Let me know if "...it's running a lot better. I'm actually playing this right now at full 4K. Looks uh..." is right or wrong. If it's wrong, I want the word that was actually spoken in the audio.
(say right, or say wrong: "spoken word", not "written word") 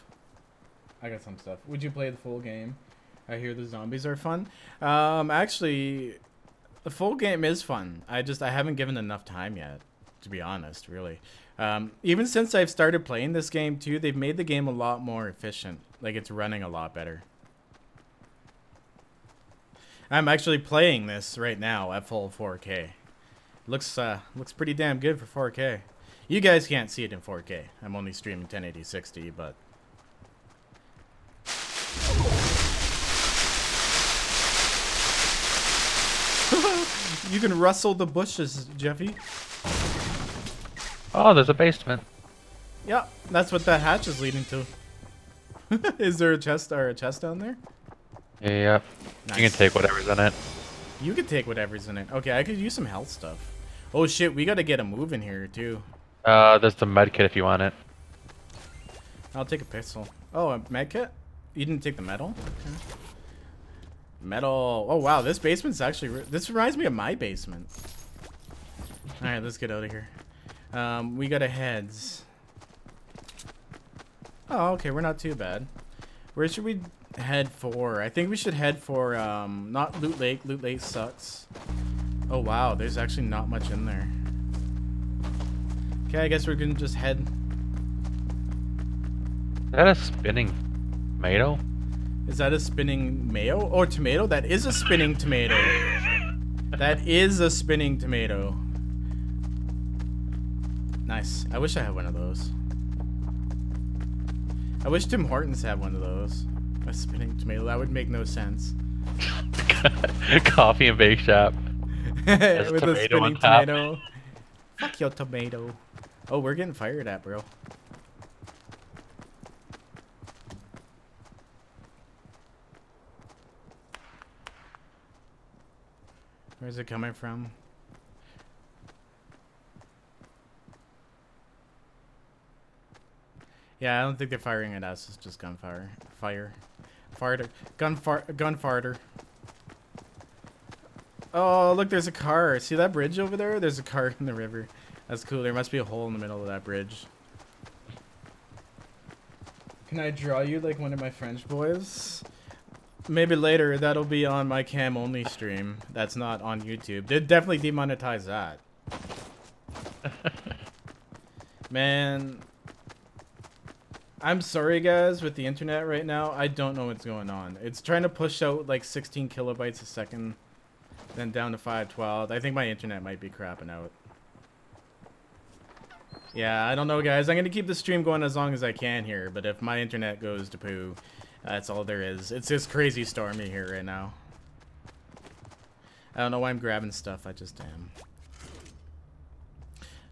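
right.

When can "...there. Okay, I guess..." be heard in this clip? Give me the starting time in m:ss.
1:23.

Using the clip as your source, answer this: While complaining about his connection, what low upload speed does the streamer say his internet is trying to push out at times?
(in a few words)
16 kilobytes a second.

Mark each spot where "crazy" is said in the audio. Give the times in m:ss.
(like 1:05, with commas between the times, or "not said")
3:02.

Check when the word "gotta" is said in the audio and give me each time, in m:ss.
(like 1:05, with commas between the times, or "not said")
0:54.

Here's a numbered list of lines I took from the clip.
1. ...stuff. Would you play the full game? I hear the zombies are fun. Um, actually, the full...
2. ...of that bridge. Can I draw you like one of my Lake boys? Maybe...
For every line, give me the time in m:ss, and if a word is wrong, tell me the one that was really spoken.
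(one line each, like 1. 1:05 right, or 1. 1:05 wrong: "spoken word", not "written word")
1. 0:01 right
2. 2:26 wrong: "French", not "Lake".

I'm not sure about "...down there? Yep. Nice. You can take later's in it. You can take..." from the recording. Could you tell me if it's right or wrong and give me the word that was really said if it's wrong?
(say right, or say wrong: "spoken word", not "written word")
wrong: "whatever", not "later".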